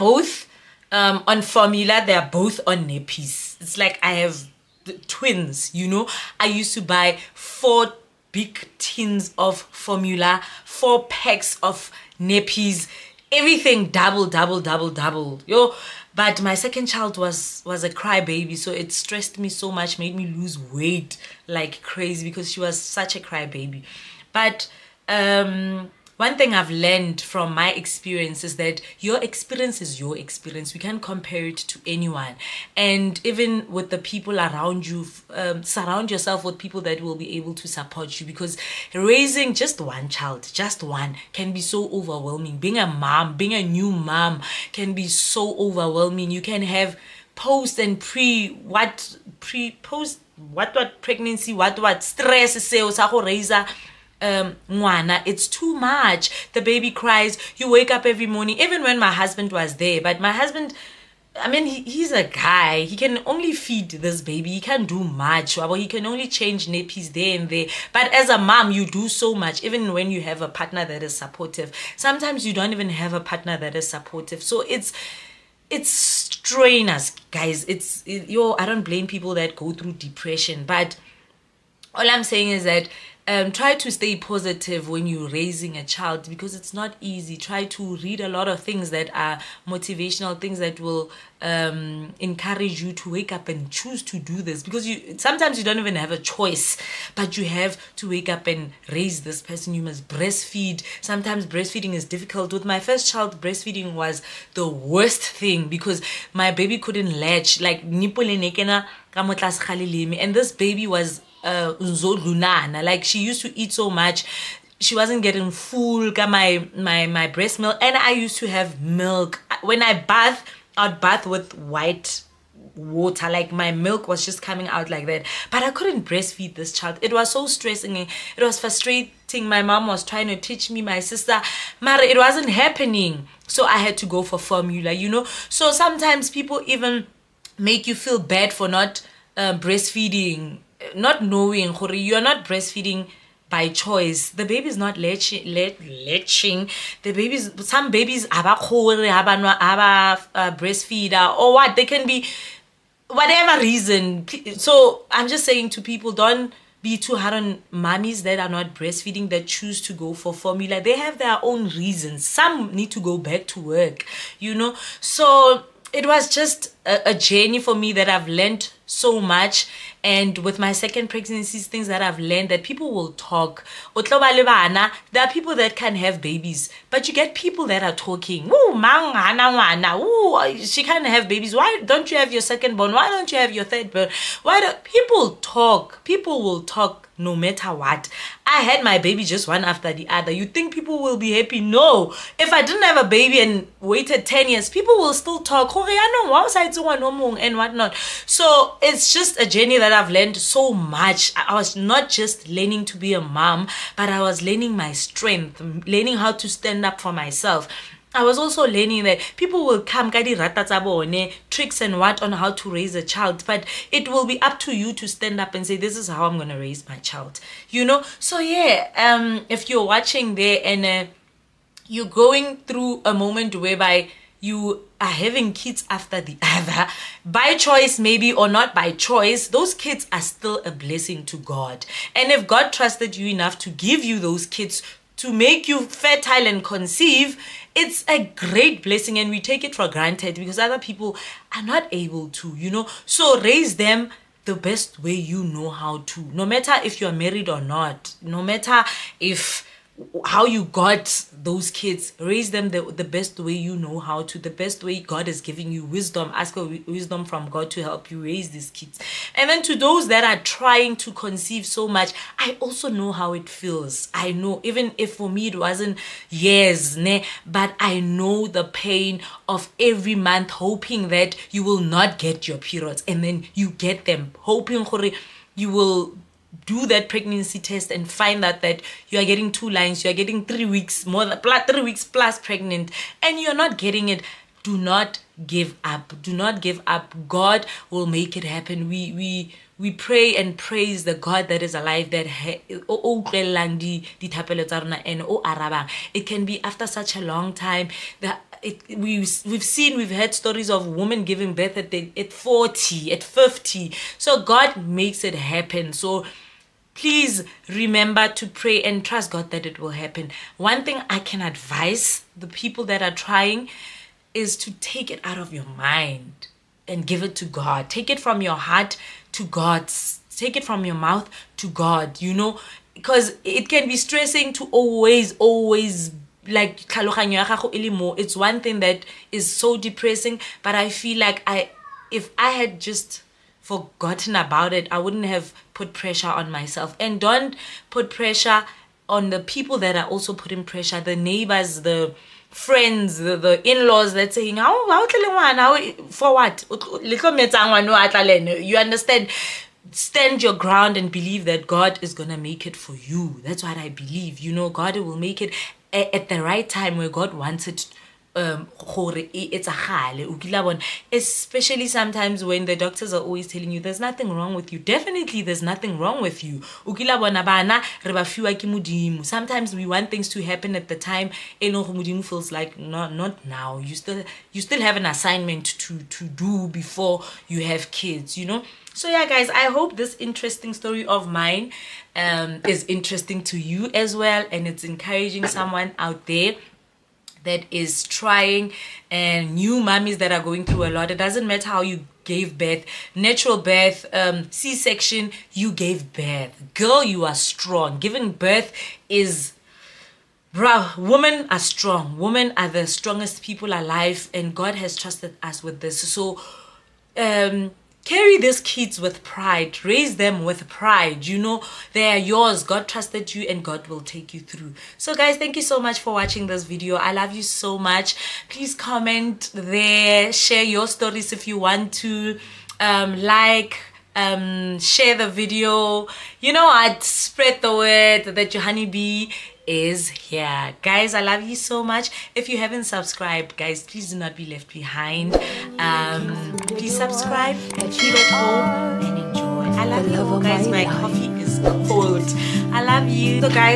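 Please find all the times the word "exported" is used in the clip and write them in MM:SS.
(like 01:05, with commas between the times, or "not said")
not said.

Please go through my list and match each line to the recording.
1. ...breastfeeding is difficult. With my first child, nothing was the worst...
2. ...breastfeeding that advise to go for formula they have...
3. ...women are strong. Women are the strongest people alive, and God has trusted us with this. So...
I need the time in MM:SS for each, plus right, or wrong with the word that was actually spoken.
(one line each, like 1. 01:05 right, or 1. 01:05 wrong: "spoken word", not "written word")
1. 01:41 wrong: "breastfeeding", not "nothing"
2. 02:38 wrong: "choose", not "advise"
3. 06:40 right.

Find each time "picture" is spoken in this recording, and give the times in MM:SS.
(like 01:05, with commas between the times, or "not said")
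not said.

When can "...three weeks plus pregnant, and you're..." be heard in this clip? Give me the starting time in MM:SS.
04:41.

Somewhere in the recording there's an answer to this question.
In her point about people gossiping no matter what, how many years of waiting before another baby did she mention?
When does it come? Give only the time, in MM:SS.
03:14.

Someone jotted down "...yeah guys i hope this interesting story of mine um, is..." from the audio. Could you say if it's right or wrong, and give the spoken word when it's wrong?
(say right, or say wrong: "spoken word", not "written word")
right.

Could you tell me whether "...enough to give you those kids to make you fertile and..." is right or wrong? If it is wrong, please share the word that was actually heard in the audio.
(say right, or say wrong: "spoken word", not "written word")
right.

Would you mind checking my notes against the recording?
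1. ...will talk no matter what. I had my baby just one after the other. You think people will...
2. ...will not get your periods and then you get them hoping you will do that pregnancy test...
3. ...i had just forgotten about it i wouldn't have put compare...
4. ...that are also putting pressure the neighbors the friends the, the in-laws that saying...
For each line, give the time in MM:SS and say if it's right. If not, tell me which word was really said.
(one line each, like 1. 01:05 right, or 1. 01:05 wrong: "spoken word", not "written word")
1. 03:06 right
2. 04:31 right
3. 05:32 wrong: "pressure", not "compare"
4. 05:39 right.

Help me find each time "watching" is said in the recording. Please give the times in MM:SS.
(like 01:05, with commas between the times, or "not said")
03:39, 06:56.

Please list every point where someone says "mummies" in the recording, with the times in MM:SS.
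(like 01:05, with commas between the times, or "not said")
02:37, 06:29.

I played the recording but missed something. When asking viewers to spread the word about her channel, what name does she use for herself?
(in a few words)
your honeybee.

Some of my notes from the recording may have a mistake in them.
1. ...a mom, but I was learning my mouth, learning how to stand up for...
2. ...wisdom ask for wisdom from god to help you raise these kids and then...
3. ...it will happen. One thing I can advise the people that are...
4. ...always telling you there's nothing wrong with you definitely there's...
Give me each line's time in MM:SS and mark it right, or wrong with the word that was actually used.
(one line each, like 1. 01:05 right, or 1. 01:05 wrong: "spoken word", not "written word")
1. 03:23 wrong: "strength", not "mouth"
2. 04:15 right
3. 05:09 right
4. 06:03 right.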